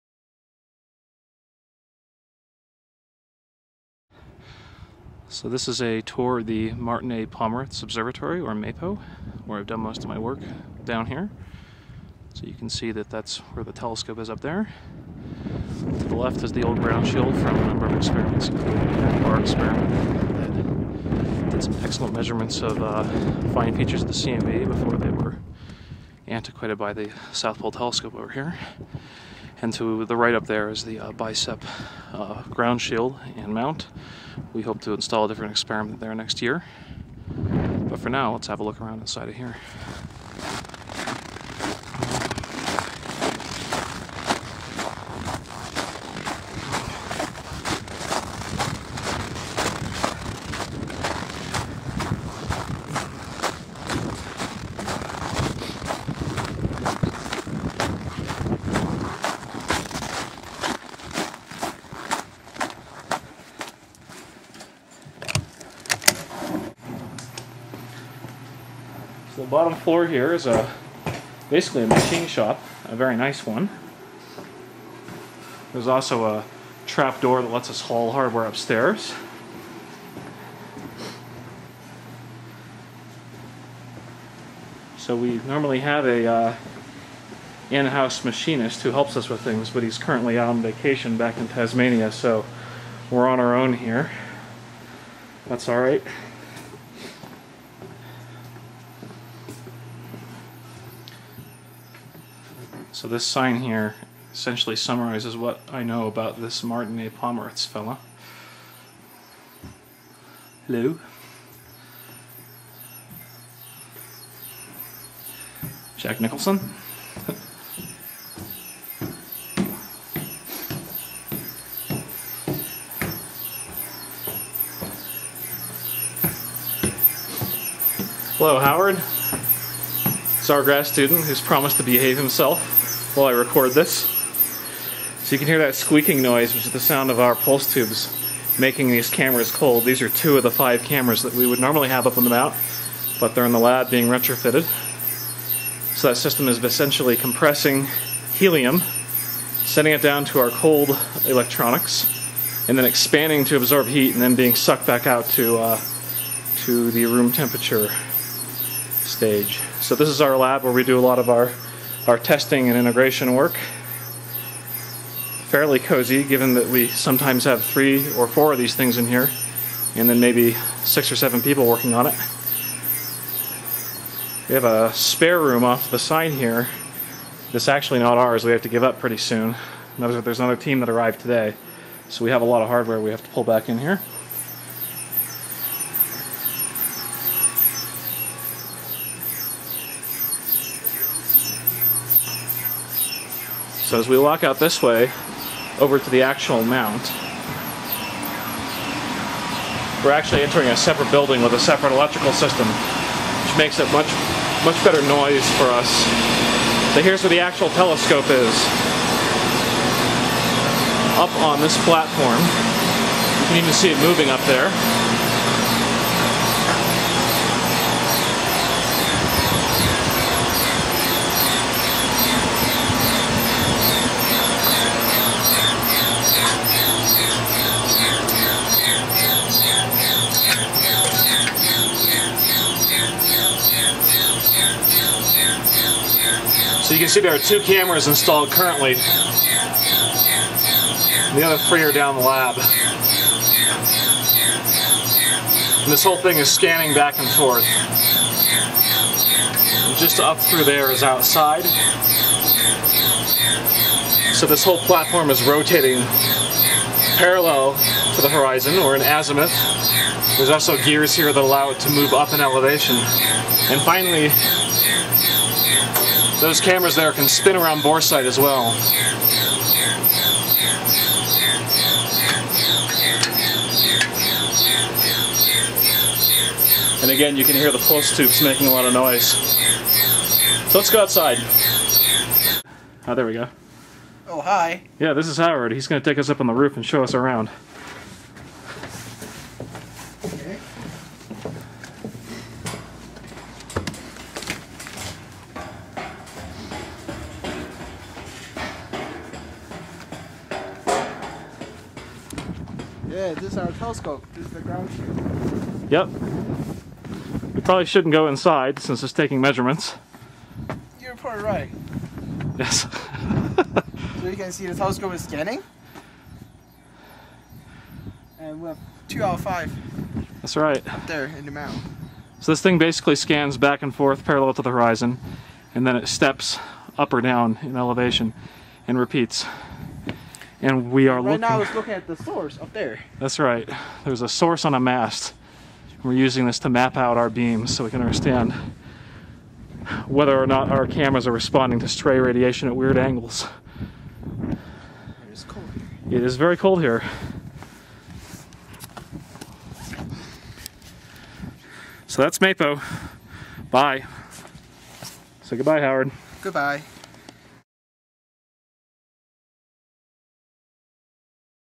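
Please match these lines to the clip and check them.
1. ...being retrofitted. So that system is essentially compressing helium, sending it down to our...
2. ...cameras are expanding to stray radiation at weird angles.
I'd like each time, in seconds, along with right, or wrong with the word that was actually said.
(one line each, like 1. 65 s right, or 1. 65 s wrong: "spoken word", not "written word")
1. 143 s right
2. 340 s wrong: "responding", not "expanding".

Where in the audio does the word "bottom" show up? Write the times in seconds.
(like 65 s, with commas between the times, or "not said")
69 s.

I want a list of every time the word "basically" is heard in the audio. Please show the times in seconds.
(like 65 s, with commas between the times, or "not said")
71 s, 322 s.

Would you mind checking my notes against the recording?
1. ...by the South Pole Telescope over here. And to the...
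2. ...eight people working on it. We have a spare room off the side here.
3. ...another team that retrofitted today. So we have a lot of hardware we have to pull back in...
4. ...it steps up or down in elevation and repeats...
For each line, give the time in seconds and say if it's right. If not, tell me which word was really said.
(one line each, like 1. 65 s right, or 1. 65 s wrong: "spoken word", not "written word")
1. 26 s right
2. 171 s wrong: "seven", not "eight"
3. 180 s wrong: "arrived", not "retrofitted"
4. 325 s right.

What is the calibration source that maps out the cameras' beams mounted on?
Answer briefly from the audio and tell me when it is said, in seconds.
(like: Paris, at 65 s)
A mast, at 334 s.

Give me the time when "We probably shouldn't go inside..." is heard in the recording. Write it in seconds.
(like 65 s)
307 s.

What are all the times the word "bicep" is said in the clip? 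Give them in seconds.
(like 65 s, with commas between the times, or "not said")
31 s.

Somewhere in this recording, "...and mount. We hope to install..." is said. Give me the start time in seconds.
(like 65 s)
33 s.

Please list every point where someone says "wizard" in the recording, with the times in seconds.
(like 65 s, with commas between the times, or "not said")
not said.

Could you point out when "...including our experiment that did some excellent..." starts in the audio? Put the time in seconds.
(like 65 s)
18 s.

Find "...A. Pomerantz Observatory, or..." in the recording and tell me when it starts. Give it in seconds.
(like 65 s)
7 s.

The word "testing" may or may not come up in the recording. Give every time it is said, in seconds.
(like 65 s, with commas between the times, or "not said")
162 s.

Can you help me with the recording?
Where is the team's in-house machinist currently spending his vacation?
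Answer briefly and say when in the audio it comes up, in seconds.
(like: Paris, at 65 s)
Tasmania, at 91 s.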